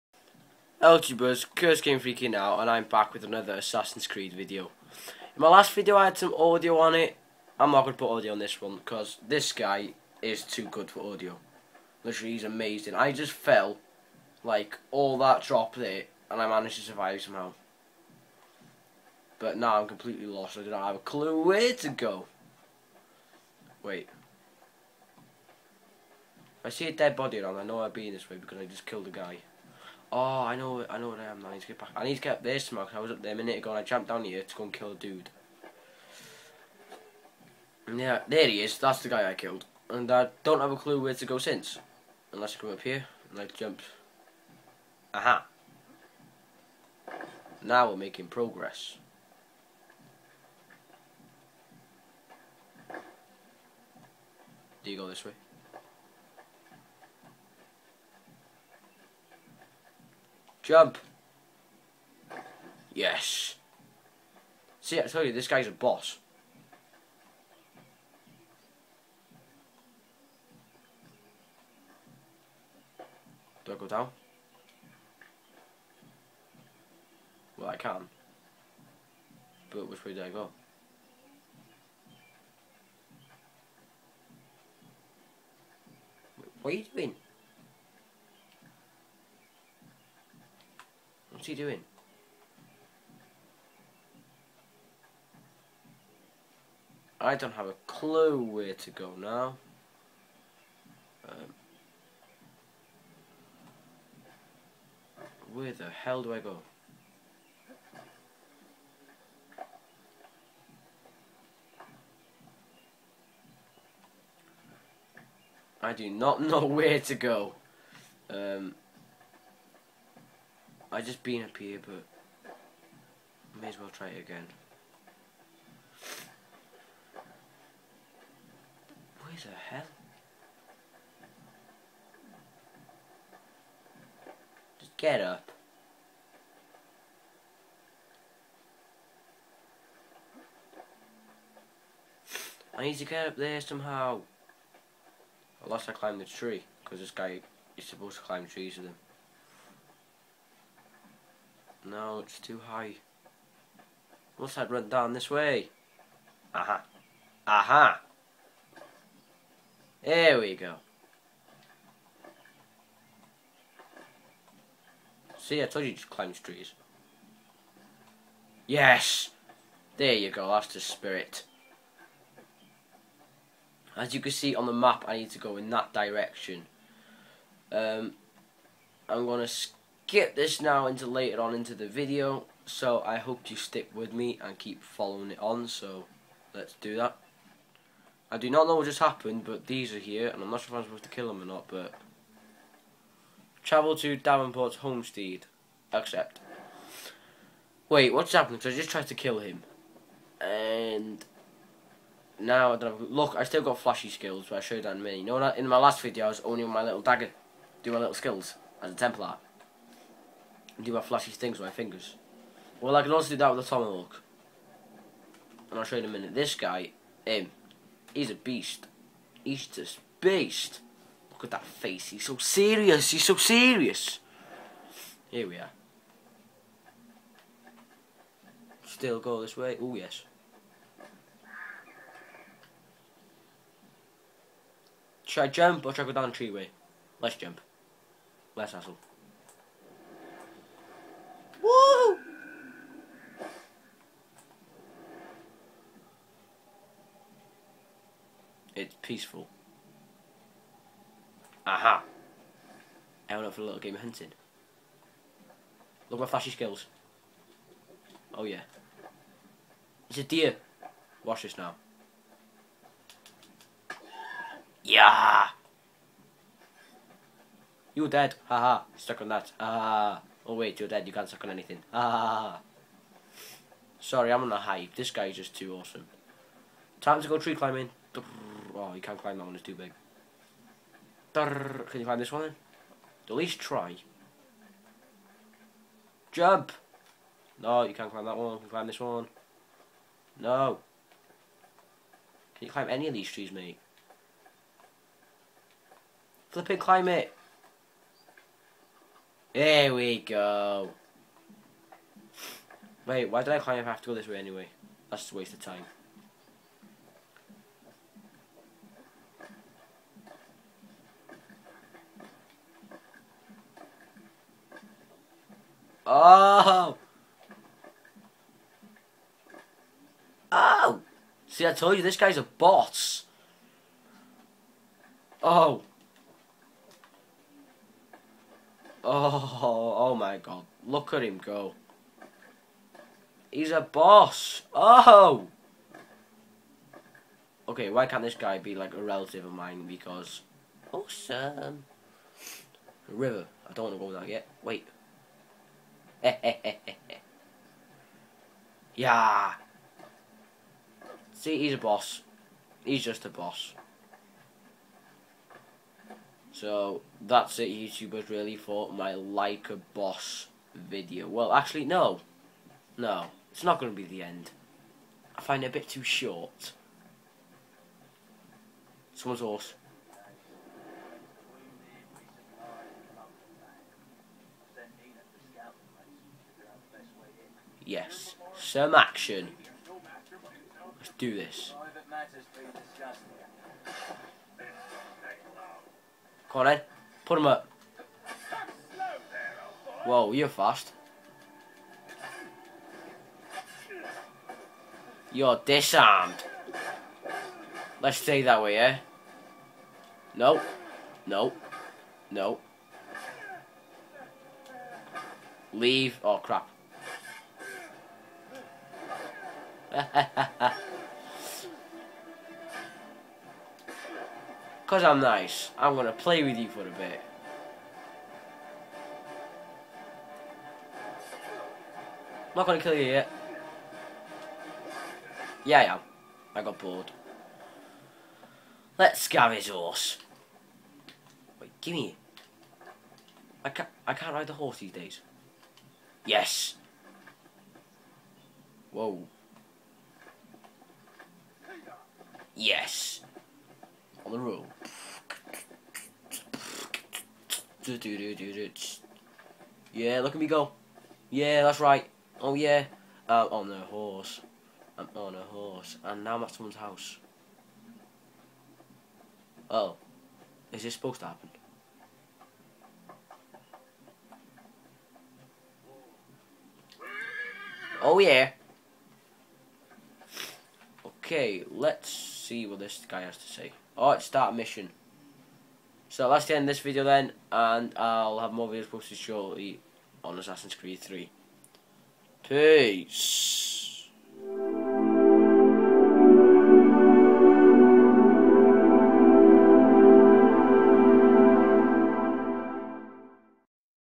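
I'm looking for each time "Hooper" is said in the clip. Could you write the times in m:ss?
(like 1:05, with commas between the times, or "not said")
not said.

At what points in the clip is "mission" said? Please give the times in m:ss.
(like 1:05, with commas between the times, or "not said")
7:54.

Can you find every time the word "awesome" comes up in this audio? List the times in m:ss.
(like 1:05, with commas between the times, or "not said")
4:35, 5:40.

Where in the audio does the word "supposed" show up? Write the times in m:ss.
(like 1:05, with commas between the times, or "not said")
2:27, 3:10, 7:40.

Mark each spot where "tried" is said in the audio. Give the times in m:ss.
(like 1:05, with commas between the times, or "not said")
3:18.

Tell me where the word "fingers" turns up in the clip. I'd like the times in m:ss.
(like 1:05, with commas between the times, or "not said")
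3:31.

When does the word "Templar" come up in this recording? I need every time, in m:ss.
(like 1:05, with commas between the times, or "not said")
3:28.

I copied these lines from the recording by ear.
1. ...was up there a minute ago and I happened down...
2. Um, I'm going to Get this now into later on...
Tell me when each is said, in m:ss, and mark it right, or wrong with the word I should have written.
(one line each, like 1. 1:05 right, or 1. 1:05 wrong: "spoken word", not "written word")
1. 0:32 wrong: "jumped", not "happened"
2. 2:57 right.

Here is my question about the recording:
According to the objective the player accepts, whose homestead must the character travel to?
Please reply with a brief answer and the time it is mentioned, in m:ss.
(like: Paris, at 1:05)
Davenport's homestead, at 3:14.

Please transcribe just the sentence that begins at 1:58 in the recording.
Um, I just been up here, but may as well try it again.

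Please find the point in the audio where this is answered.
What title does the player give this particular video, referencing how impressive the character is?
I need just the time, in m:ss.
5:59.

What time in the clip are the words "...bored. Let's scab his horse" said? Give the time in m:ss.
7:06.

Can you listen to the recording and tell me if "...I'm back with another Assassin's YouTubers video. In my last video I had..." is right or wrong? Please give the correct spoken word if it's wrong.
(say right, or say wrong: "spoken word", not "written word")
wrong: "Creed", not "YouTubers".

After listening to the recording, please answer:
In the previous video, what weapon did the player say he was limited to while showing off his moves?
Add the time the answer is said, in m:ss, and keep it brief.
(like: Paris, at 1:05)
little dagger, at 3:26.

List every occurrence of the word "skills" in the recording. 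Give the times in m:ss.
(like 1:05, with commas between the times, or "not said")
3:24, 3:28, 4:16.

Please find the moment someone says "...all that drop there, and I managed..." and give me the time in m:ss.
0:14.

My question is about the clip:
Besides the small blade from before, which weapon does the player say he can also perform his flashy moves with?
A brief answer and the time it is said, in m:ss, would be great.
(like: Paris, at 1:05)
tomahawk, at 3:33.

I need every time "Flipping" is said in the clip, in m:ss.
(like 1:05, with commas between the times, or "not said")
4:56.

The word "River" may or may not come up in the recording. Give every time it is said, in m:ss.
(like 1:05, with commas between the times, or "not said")
5:43.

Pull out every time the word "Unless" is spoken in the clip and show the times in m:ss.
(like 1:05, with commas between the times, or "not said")
0:42, 2:25.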